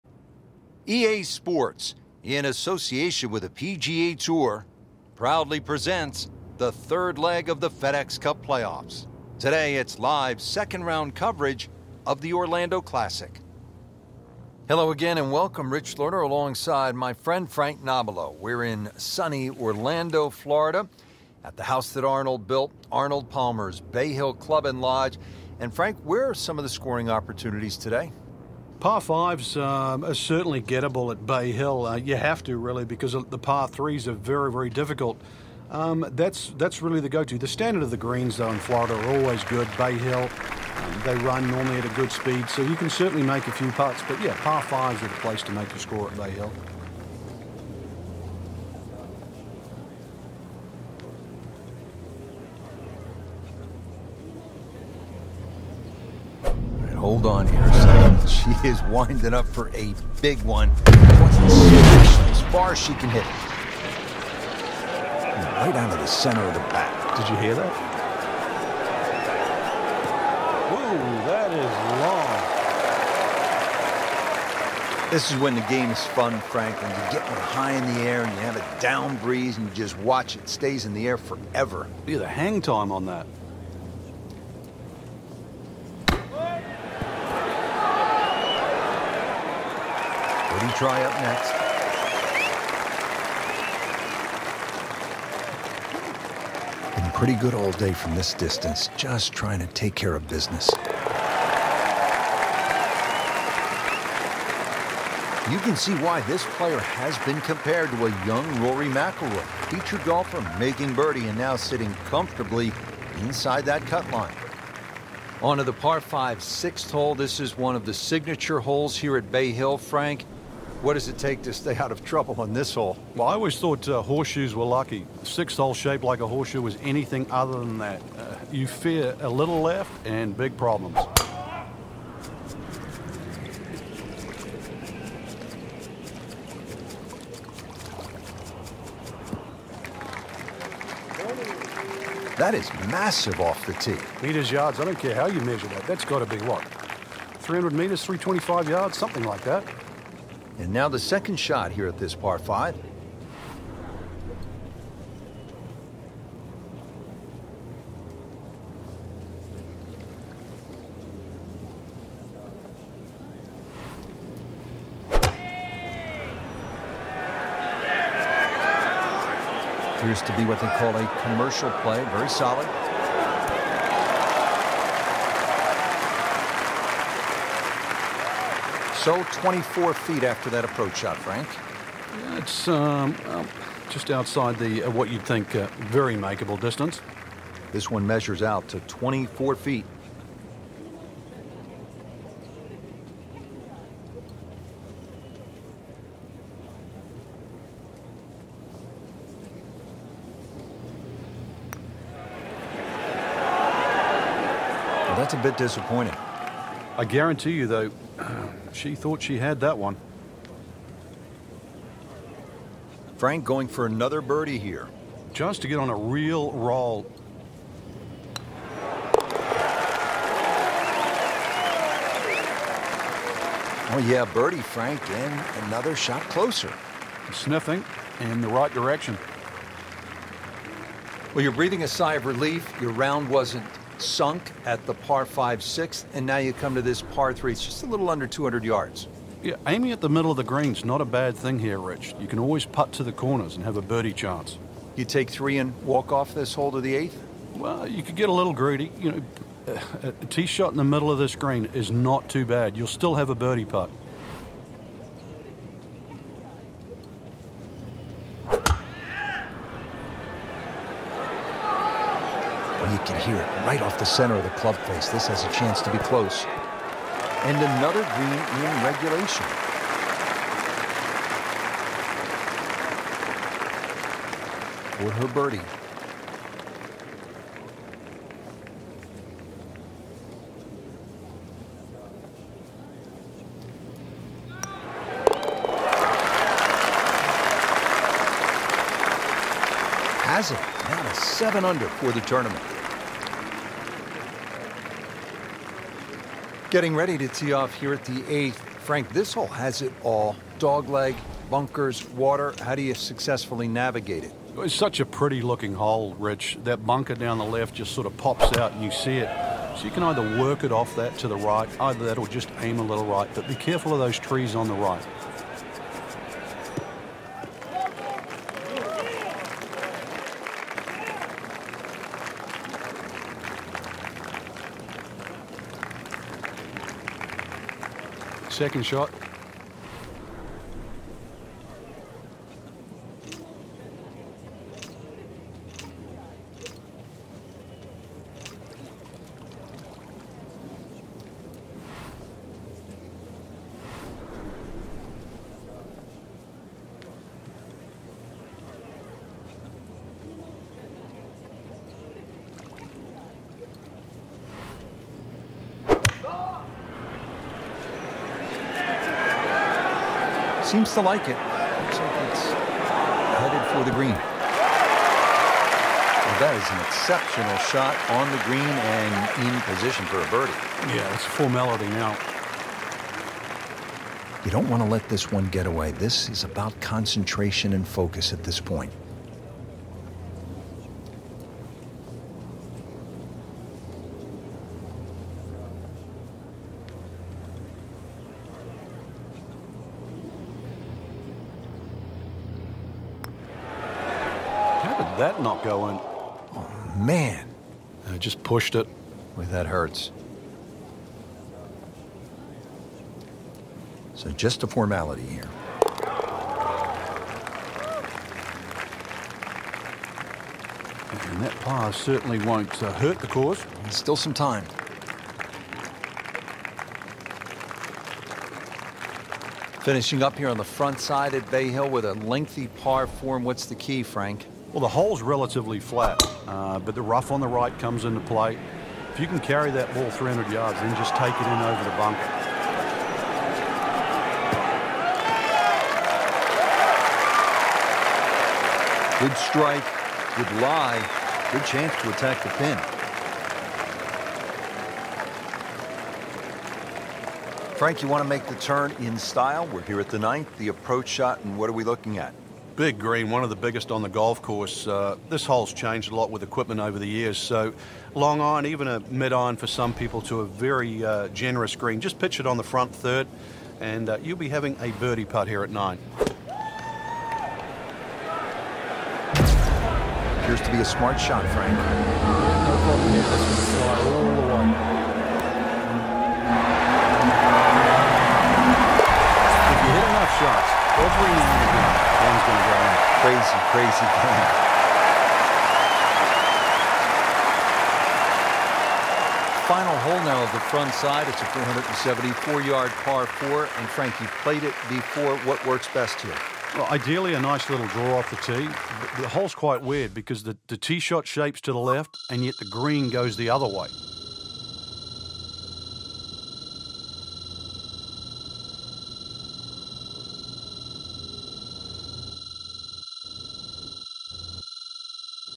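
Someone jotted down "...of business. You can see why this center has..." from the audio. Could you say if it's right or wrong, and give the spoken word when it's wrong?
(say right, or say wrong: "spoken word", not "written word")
wrong: "player", not "center".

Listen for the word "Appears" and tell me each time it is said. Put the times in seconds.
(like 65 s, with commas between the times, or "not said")
169 s, 470 s.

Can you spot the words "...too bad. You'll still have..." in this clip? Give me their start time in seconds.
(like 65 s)
252 s.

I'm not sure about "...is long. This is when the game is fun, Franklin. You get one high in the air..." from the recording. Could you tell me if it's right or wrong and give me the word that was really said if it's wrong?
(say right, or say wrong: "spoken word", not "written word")
right.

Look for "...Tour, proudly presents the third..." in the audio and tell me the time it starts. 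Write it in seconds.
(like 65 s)
4 s.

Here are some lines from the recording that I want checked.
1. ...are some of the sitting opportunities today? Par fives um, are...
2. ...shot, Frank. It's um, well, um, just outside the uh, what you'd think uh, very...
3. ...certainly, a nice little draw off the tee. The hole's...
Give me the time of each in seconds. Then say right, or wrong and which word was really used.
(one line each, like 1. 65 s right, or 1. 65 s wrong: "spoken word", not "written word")
1. 26 s wrong: "scoring", not "sitting"
2. 180 s right
3. 496 s wrong: "ideally", not "certainly".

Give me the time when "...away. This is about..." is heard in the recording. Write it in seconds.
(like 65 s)
375 s.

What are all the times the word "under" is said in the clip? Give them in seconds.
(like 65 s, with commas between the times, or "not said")
238 s, 291 s.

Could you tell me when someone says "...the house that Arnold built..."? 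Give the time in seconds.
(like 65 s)
21 s.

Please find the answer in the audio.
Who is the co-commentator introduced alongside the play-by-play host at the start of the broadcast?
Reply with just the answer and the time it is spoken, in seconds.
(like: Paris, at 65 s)
Frank Nobilo, at 17 s.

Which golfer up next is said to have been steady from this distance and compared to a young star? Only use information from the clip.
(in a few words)
Cody Try.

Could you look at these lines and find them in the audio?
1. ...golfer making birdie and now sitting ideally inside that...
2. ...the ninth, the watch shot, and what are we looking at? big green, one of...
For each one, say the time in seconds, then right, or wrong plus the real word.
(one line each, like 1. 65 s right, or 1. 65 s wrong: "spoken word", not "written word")
1. 110 s wrong: "comfortably", not "ideally"
2. 450 s wrong: "approach", not "watch".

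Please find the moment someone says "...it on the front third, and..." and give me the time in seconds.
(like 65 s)
462 s.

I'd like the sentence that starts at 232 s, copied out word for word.
Your round wasn't sunk at the par 5 and now you come to this par 3.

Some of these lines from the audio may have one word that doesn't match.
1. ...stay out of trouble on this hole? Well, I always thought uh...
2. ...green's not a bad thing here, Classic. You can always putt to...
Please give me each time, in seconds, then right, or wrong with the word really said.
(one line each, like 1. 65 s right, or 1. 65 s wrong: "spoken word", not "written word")
1. 121 s right
2. 240 s wrong: "Rich", not "Classic".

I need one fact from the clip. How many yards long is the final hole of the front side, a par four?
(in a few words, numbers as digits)
474.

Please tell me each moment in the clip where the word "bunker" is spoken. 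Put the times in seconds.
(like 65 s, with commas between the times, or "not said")
301 s, 306 s, 431 s.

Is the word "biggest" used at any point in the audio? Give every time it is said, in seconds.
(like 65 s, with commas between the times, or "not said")
453 s.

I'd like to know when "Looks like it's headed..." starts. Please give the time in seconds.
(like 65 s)
361 s.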